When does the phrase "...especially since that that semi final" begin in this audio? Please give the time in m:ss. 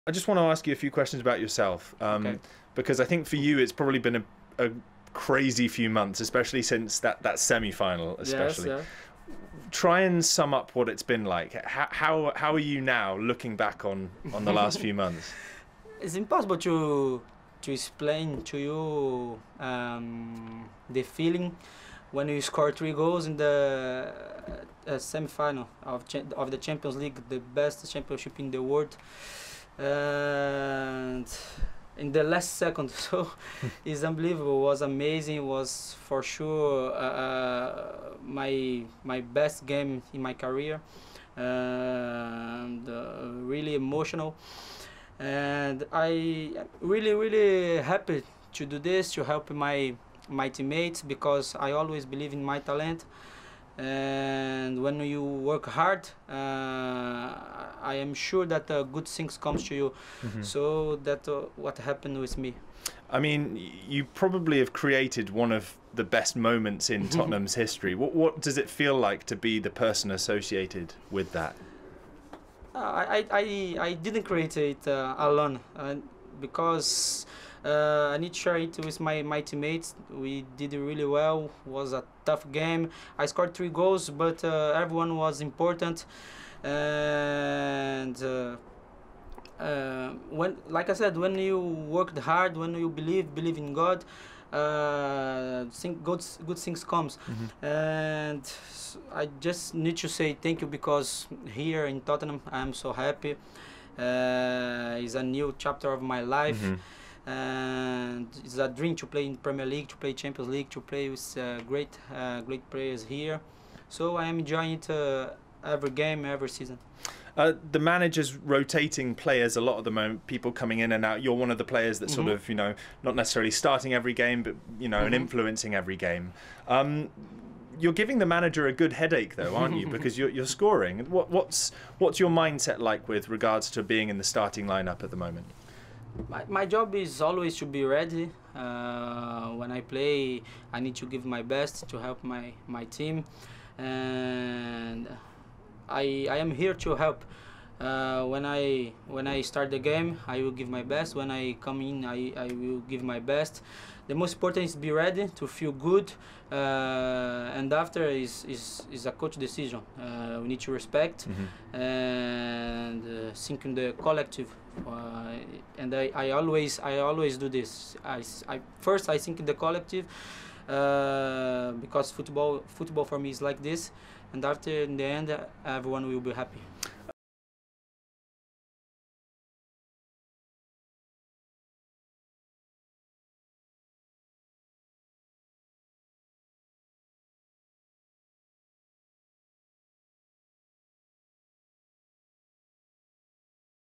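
0:06.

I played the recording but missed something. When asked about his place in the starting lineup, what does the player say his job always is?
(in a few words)
to be ready.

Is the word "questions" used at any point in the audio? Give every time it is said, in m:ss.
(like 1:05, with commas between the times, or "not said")
0:00.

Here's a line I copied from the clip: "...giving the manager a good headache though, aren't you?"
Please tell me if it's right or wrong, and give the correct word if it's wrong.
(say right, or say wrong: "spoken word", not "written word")
right.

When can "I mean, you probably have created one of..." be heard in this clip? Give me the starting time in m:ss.
1:03.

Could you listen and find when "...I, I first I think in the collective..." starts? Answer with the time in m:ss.
2:48.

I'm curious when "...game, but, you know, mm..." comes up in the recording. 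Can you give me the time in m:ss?
2:04.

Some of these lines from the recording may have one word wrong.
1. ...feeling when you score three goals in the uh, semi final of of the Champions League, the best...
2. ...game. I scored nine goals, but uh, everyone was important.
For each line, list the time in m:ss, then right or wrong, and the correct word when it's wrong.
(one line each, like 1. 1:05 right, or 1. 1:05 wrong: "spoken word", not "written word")
1. 0:21 right
2. 1:22 wrong: "three", not "nine".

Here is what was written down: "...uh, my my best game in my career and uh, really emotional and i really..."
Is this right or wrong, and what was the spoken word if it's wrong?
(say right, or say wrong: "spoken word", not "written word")
right.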